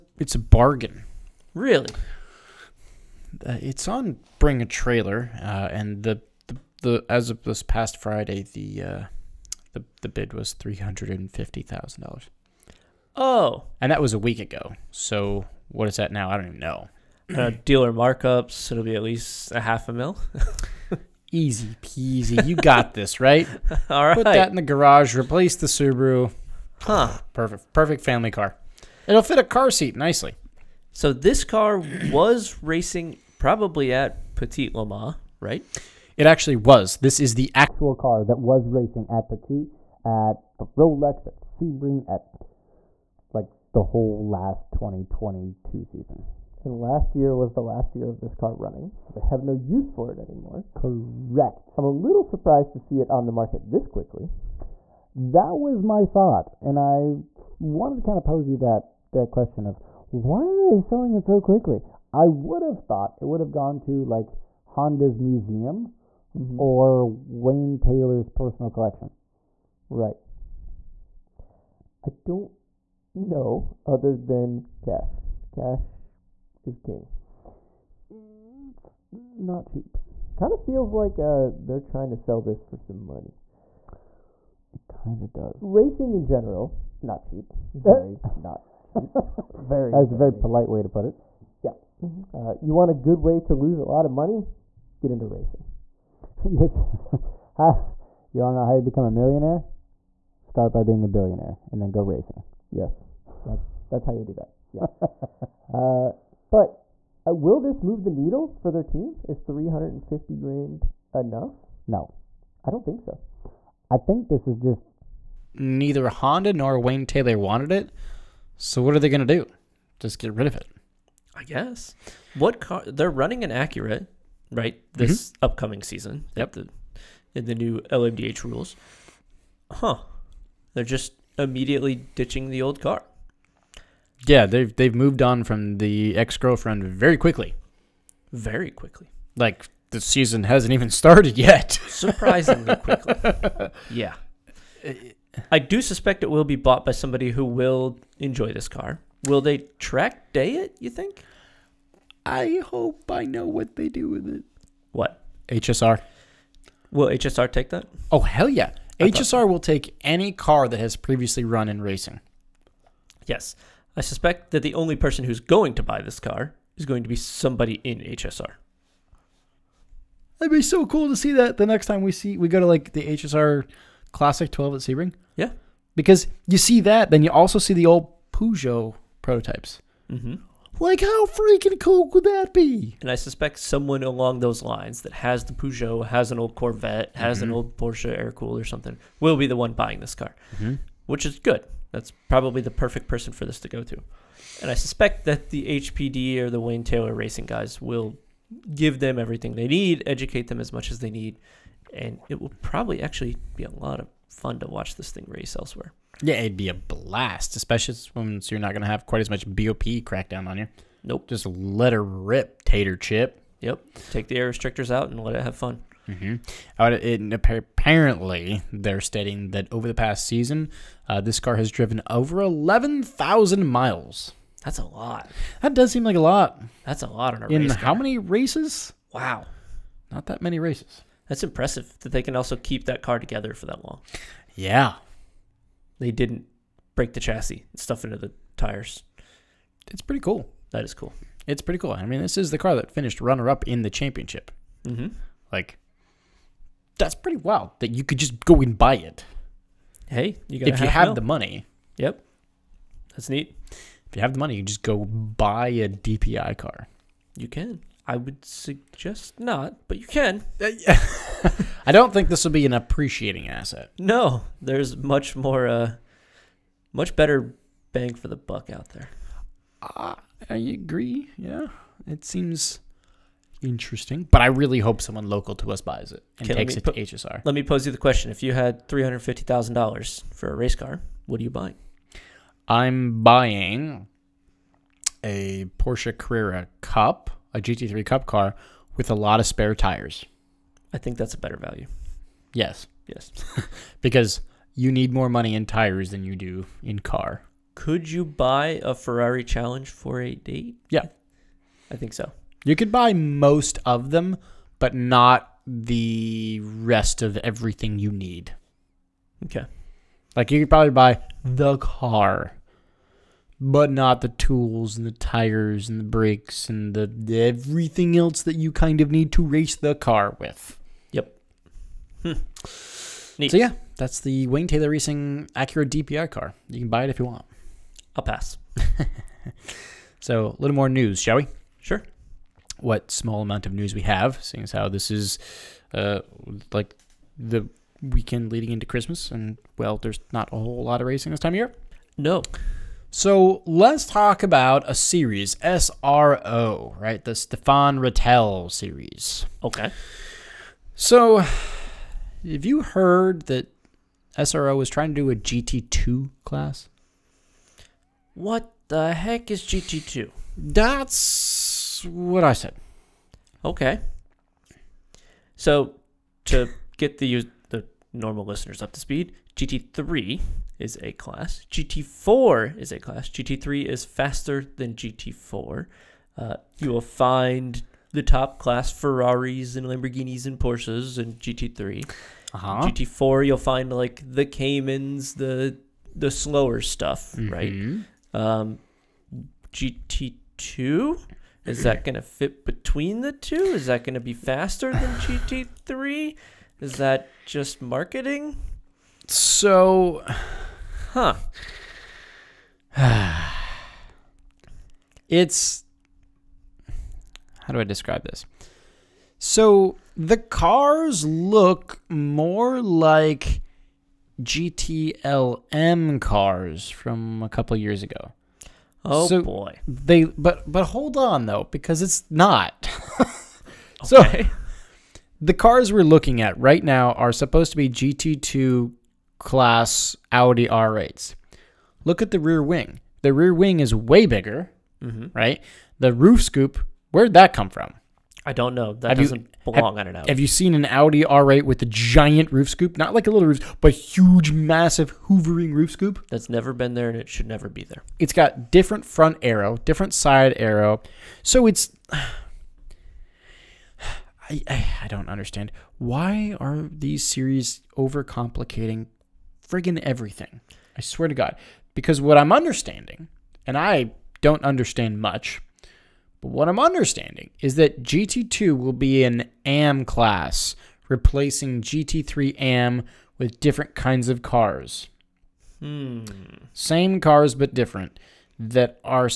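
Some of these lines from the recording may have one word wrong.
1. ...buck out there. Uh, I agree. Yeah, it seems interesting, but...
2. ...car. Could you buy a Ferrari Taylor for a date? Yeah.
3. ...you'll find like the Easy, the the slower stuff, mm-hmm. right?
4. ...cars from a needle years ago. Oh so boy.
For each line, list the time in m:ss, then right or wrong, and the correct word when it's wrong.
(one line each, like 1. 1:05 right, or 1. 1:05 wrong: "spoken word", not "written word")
1. 4:28 right
2. 4:56 wrong: "Challenge", not "Taylor"
3. 6:23 wrong: "Caymans", not "Easy"
4. 6:56 wrong: "couple", not "needle".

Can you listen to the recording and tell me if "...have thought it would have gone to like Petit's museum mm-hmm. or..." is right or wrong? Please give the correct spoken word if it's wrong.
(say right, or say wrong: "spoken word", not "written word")
wrong: "Honda", not "Petit".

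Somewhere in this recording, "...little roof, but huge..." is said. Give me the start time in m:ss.
7:23.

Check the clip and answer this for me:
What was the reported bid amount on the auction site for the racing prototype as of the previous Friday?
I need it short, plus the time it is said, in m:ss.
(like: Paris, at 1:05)
$350,000, at 0:10.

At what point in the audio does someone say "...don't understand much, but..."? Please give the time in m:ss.
7:44.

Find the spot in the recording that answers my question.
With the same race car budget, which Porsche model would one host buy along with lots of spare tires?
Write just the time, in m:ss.
4:47.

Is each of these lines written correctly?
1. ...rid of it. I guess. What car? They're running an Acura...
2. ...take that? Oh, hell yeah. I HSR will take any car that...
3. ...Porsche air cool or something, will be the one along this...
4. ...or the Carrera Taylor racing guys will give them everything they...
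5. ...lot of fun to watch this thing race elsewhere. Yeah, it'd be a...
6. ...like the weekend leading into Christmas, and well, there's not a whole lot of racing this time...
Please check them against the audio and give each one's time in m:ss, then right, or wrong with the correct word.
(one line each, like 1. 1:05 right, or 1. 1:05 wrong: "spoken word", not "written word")
1. 2:00 right
2. 2:37 right
3. 3:07 wrong: "buying", not "along"
4. 3:16 wrong: "Wayne", not "Carrera"
5. 3:23 right
6. 5:36 right.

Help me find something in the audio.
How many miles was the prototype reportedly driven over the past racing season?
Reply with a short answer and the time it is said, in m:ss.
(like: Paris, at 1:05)
11,000, at 3:42.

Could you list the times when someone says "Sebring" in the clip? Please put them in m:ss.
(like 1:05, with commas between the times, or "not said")
0:41, 2:54.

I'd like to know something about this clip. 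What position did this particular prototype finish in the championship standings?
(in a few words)
Runner up.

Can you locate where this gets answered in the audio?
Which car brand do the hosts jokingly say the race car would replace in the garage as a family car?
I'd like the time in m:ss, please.
0:25.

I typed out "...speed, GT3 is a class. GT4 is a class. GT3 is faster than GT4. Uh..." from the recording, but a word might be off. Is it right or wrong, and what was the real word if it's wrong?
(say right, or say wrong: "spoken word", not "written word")
right.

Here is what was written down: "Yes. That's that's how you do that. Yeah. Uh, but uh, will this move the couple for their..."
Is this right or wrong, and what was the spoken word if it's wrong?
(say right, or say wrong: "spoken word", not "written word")
wrong: "needle", not "couple".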